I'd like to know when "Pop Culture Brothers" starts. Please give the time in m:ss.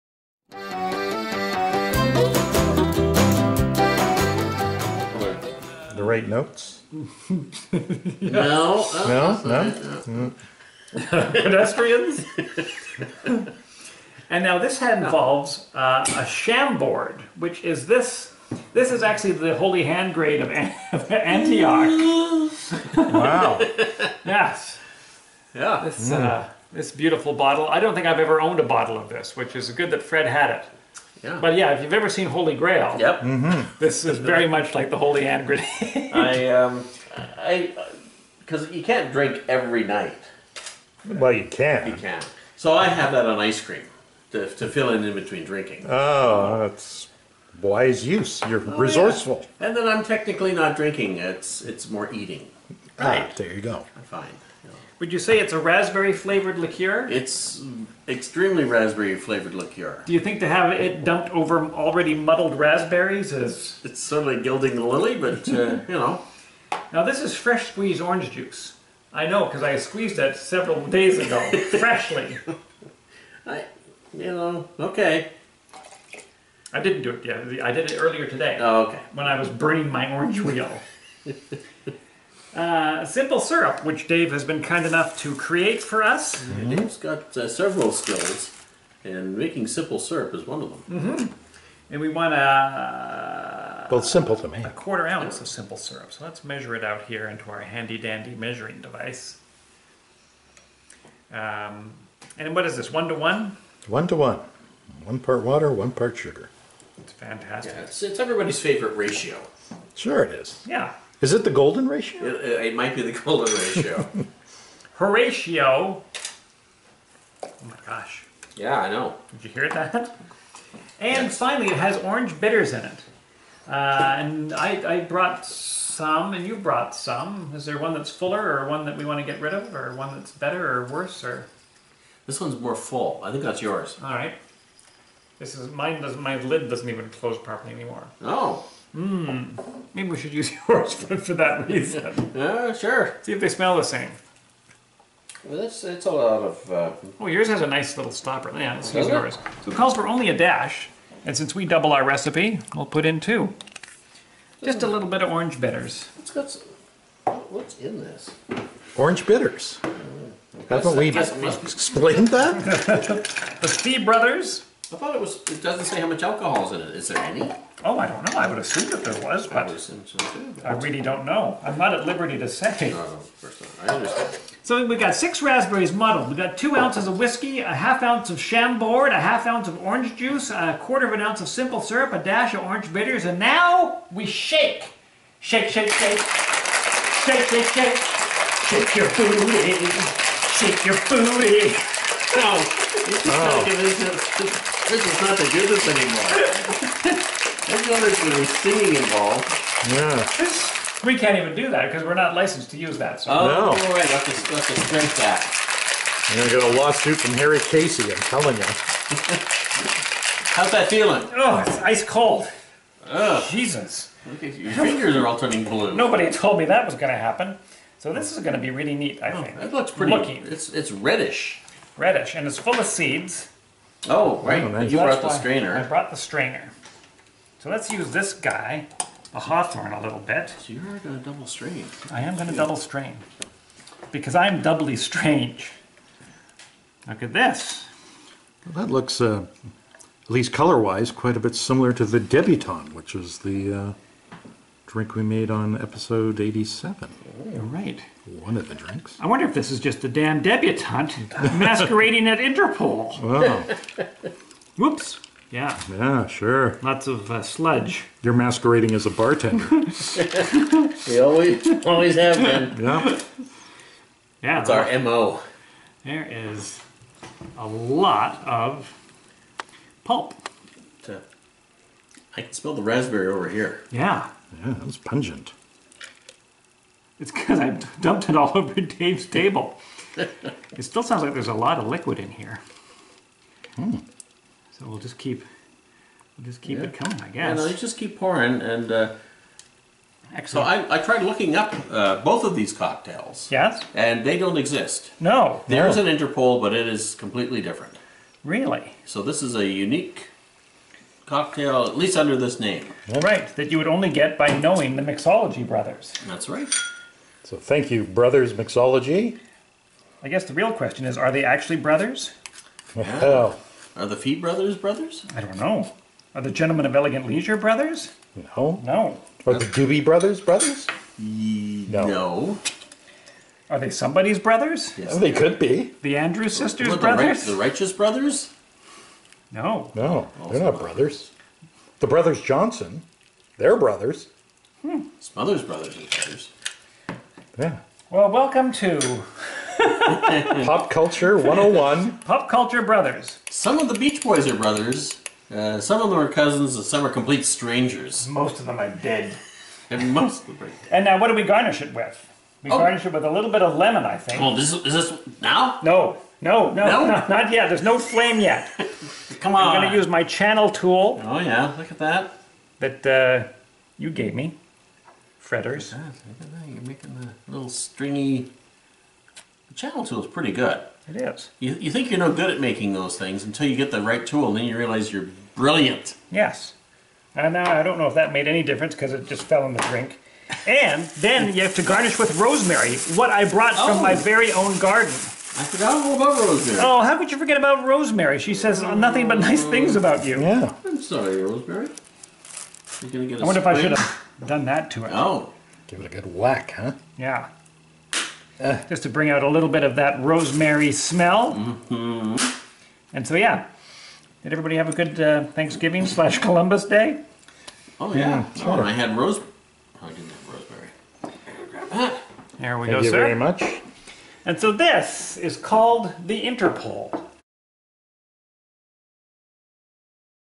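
5:42.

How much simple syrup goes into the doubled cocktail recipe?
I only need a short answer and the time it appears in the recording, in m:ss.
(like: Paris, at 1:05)
a quarter ounce, at 1:34.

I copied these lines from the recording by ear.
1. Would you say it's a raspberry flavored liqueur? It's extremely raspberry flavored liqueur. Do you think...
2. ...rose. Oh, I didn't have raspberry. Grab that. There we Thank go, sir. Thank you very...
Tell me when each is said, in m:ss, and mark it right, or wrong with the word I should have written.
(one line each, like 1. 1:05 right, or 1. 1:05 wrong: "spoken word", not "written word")
1. 0:54 right
2. 6:49 wrong: "rosemary", not "raspberry".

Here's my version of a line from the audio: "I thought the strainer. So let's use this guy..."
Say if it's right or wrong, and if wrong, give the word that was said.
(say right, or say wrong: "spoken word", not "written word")
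wrong: "brought", not "thought".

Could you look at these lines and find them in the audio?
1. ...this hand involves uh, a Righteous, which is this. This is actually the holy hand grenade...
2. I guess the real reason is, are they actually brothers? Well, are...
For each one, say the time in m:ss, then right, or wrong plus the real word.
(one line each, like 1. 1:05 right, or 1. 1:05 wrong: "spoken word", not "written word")
1. 0:14 wrong: "Chambord", not "Righteous"
2. 5:10 wrong: "question", not "reason".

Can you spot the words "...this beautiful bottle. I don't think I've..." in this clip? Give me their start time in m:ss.
0:26.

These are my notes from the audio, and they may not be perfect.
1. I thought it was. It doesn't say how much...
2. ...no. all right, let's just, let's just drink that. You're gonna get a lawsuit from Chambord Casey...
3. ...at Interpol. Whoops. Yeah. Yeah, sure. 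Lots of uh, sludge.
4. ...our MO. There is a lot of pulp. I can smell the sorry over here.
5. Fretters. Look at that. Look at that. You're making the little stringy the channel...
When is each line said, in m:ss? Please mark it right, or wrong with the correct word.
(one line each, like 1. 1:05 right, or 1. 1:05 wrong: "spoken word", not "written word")
1. 2:44 right
2. 3:23 wrong: "Harry", not "Chambord"
3. 4:12 right
4. 4:24 wrong: "raspberry", not "sorry"
5. 6:05 right.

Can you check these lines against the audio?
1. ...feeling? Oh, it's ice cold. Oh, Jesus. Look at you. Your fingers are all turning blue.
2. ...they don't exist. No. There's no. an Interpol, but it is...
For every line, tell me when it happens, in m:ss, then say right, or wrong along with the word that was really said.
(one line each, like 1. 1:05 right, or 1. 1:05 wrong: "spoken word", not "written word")
1. 3:30 right
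2. 4:54 right.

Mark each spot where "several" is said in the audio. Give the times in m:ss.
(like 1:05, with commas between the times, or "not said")
1:10, 1:27.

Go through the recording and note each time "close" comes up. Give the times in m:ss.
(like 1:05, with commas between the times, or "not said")
2:17.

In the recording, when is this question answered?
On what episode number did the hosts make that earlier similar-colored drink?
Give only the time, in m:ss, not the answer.
4:05.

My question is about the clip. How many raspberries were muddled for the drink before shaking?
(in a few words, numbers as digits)
6.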